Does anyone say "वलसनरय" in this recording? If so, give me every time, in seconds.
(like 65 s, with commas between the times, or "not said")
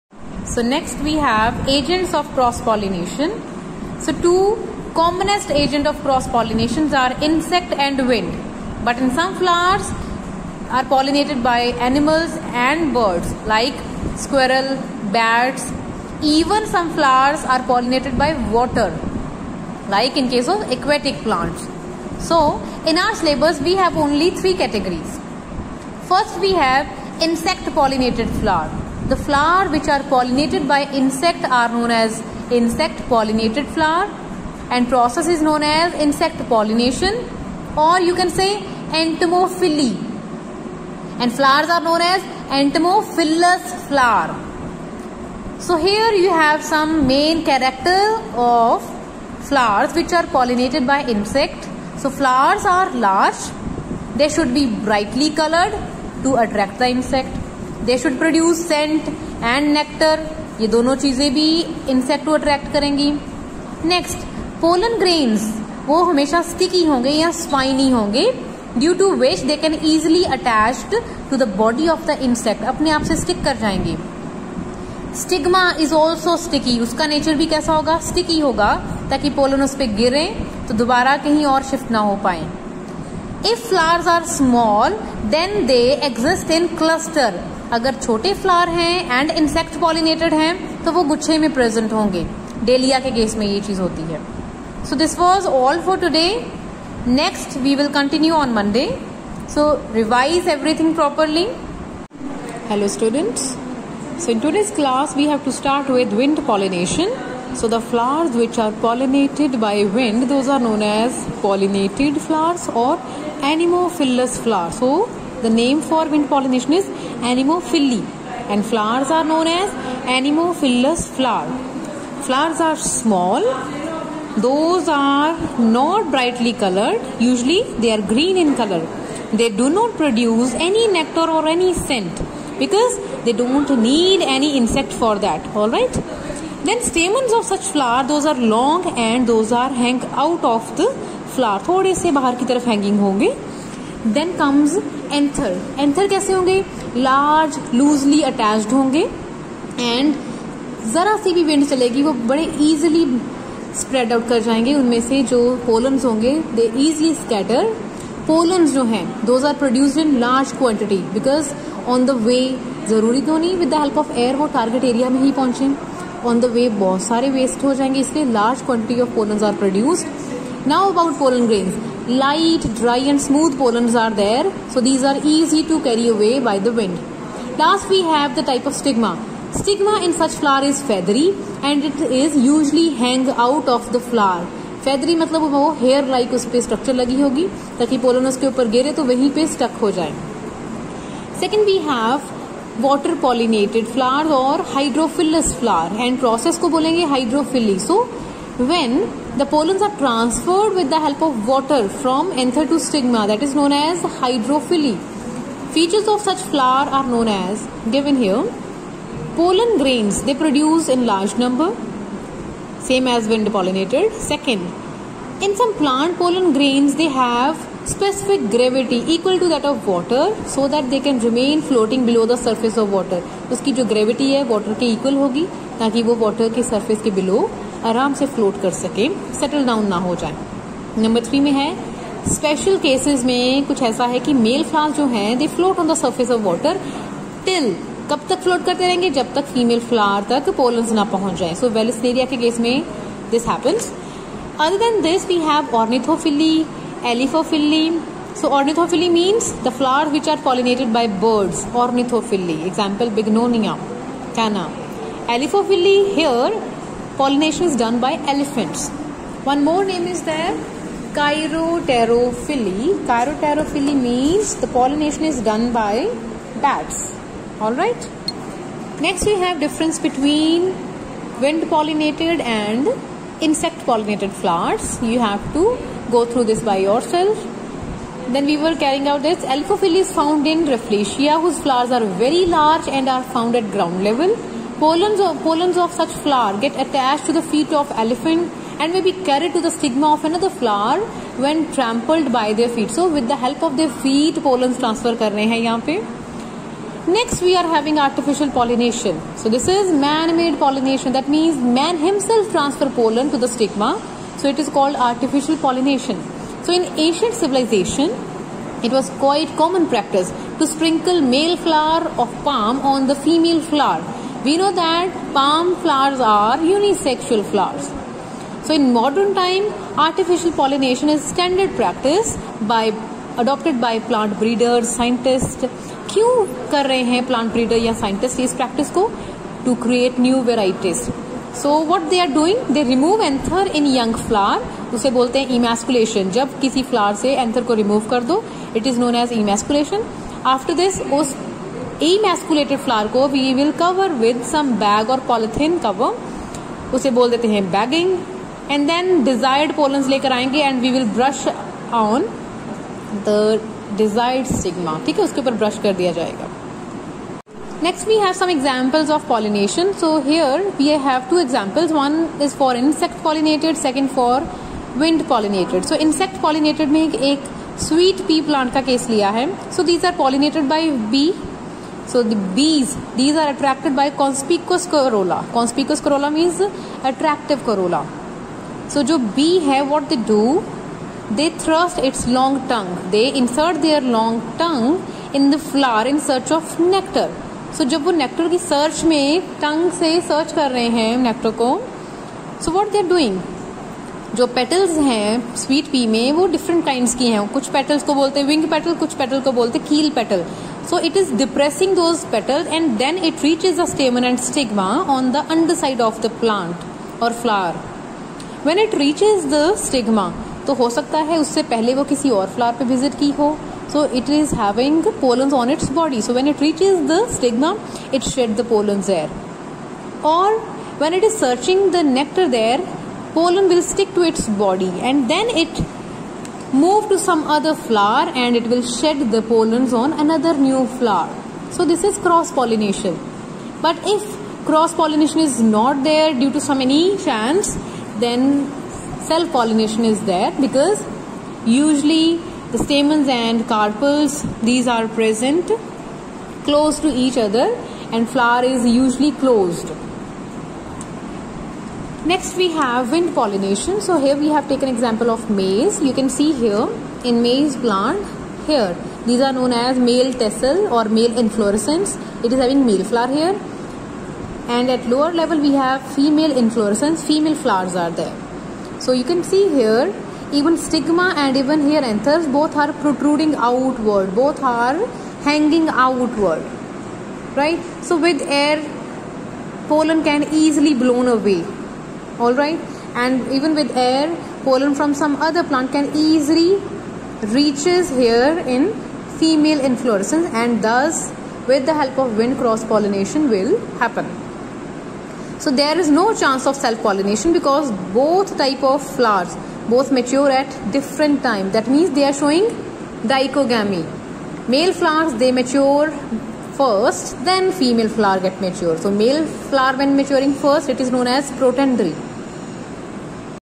241 s.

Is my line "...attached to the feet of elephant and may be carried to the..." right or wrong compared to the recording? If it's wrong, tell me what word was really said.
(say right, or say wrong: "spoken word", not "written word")
right.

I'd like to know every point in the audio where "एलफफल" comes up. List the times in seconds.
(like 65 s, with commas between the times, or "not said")
247 s, 255 s.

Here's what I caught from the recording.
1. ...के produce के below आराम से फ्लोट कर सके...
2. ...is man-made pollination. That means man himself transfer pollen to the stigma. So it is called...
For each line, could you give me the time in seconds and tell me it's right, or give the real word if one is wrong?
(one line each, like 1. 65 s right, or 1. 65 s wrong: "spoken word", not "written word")
1. 226 s wrong: "surface", not "produce"
2. 299 s right.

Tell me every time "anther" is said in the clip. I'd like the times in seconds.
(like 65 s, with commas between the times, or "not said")
202 s, 472 s.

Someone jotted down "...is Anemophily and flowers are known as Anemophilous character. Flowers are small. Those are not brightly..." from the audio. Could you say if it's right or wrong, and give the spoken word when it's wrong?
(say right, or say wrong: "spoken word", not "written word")
wrong: "flower", not "character".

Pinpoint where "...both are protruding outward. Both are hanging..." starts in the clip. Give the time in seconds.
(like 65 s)
472 s.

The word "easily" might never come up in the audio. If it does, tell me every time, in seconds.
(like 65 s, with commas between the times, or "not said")
480 s, 486 s.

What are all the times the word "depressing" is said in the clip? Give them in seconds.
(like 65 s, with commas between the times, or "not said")
401 s.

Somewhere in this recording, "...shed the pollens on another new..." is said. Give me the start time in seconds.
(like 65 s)
428 s.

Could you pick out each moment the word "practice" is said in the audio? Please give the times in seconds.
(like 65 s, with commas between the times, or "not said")
309 s, 321 s, 328 s.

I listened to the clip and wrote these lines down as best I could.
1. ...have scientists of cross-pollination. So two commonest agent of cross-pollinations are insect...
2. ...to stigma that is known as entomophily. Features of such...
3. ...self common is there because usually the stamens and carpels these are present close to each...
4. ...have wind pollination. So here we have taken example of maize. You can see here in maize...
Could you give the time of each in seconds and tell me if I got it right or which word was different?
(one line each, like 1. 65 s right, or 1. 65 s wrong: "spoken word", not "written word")
1. 1 s wrong: "agents", not "scientists"
2. 202 s wrong: "hydrophily", not "entomophily"
3. 439 s wrong: "pollination", not "common"
4. 452 s right.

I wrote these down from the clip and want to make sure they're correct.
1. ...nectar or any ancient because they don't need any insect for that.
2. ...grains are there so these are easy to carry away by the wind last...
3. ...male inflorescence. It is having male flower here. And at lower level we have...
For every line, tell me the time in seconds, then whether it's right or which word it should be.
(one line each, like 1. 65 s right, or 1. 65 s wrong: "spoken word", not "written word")
1. 130 s wrong: "scent", not "ancient"
2. 173 s wrong: "pollens", not "grains"
3. 461 s right.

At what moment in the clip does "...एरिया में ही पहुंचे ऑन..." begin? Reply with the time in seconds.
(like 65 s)
164 s.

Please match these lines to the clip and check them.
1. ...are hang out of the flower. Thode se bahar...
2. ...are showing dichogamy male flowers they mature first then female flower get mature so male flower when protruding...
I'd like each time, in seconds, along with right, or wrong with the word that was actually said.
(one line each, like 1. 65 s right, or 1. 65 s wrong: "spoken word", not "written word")
1. 139 s right
2. 502 s wrong: "maturing", not "protruding".